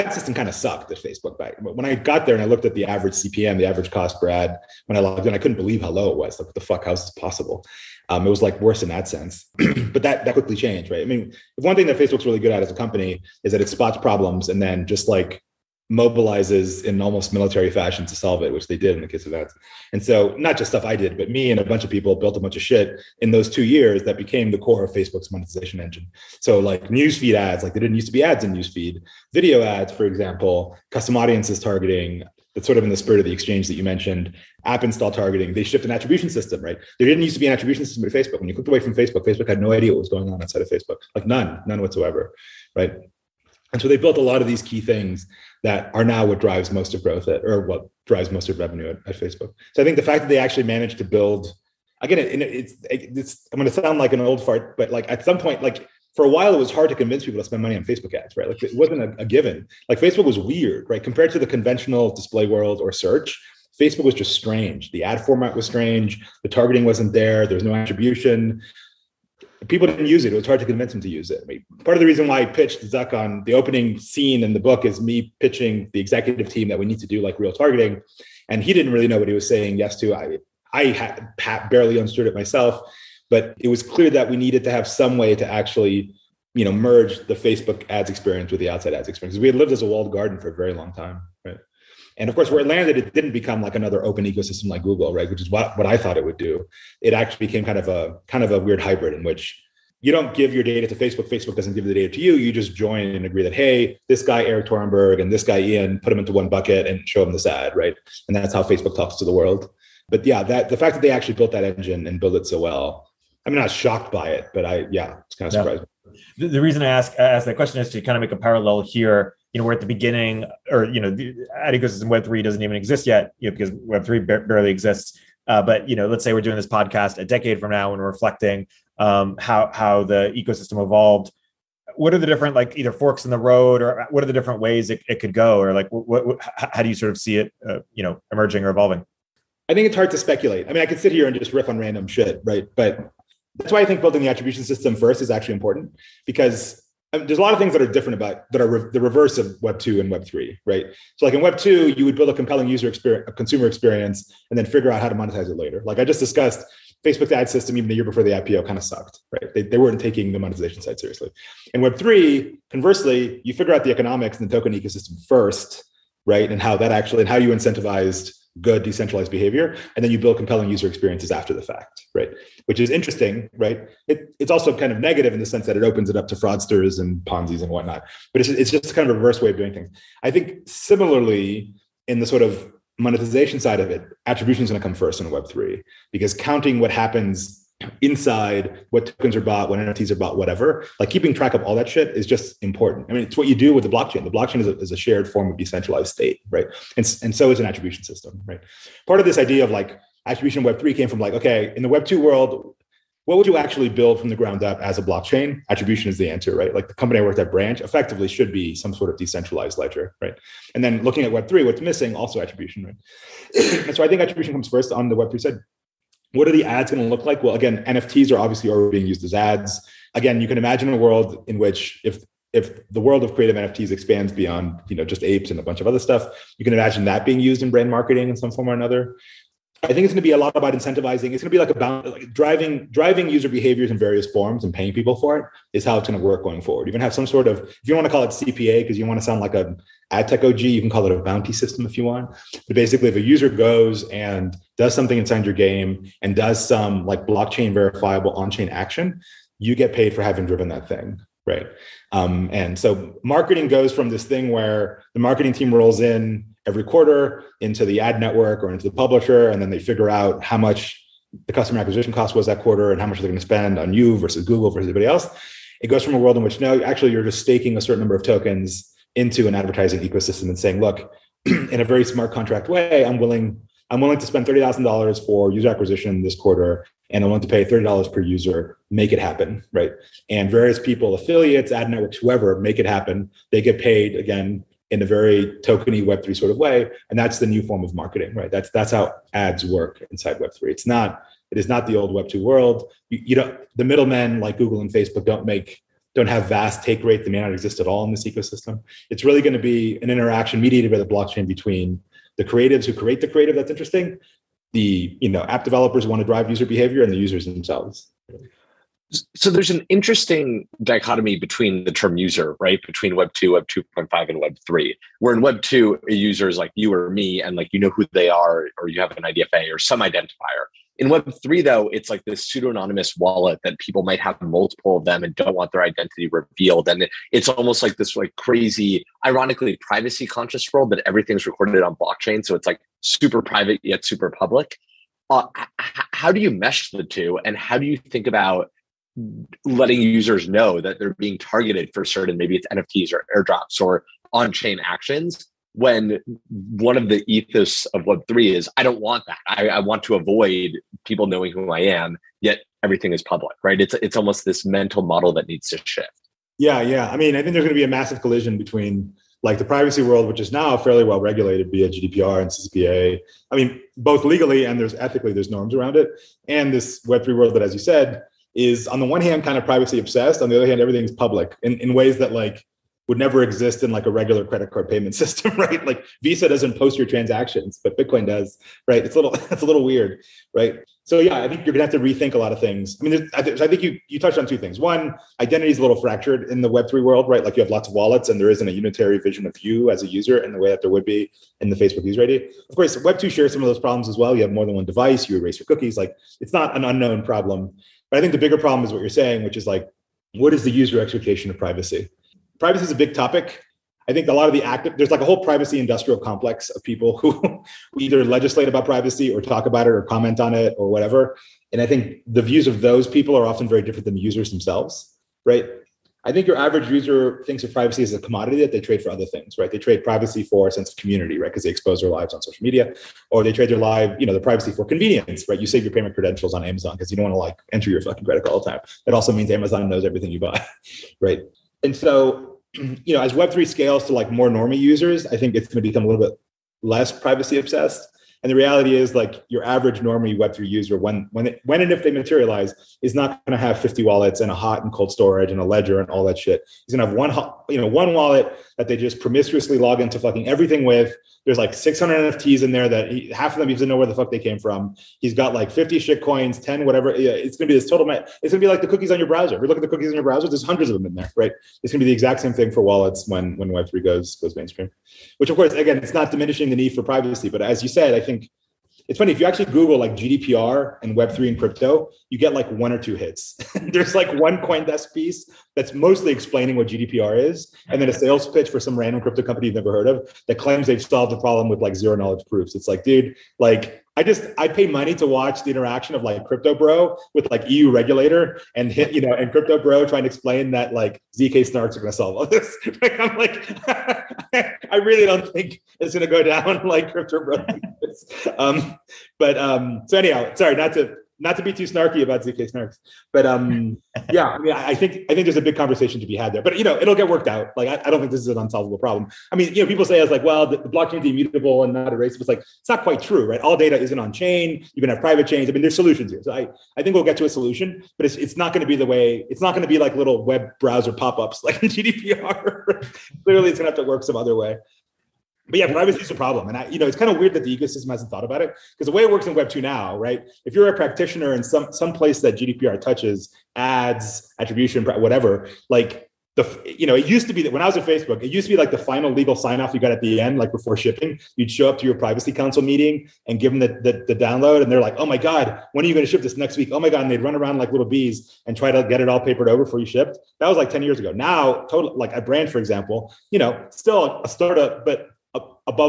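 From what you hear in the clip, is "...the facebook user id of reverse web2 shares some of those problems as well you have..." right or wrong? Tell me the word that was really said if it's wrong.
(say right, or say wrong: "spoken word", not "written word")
wrong: "course", not "reverse".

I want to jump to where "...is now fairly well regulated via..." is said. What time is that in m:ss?
6:00.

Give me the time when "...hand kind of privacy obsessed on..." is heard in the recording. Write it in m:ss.
6:09.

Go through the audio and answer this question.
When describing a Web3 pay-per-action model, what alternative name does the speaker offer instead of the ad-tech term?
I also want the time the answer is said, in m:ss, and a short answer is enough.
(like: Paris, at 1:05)
bounty system, at 4:01.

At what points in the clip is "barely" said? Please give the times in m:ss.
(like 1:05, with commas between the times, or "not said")
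1:21, 2:04.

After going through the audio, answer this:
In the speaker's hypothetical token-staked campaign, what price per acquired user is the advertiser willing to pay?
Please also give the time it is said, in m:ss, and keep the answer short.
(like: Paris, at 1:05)
$30, at 4:37.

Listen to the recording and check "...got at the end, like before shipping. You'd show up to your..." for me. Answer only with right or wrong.
right.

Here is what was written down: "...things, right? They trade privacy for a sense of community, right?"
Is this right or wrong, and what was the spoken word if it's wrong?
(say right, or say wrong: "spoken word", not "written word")
right.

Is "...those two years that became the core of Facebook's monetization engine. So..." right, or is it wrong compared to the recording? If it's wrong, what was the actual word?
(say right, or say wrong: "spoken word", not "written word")
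right.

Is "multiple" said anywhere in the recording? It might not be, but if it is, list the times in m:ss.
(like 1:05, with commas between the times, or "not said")
5:24.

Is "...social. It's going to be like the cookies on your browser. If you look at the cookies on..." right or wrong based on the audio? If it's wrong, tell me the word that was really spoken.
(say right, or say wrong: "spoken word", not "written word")
wrong: "total", not "social".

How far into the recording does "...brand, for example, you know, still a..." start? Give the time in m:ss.
9:12.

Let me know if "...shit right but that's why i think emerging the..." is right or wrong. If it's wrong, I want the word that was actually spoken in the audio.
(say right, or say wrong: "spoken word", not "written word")
wrong: "building", not "emerging".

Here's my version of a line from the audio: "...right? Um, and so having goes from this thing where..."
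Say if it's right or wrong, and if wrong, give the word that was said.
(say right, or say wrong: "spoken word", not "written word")
wrong: "marketing", not "having".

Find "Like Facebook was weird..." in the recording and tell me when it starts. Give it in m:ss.
0:59.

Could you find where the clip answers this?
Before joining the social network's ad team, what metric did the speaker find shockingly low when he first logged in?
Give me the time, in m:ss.
0:03.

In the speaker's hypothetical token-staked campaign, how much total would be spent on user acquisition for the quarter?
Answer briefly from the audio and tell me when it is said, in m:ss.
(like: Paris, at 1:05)
$30,000, at 4:34.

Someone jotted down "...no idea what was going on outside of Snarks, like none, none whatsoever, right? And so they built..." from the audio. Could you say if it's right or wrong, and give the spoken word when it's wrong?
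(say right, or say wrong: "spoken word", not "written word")
wrong: "Facebook", not "Snarks".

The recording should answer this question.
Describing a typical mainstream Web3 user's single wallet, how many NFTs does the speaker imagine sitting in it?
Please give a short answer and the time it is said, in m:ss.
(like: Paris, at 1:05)
600, at 7:31.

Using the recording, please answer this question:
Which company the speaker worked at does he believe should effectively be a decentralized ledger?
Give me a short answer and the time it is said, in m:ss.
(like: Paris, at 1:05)
Branch, at 3:27.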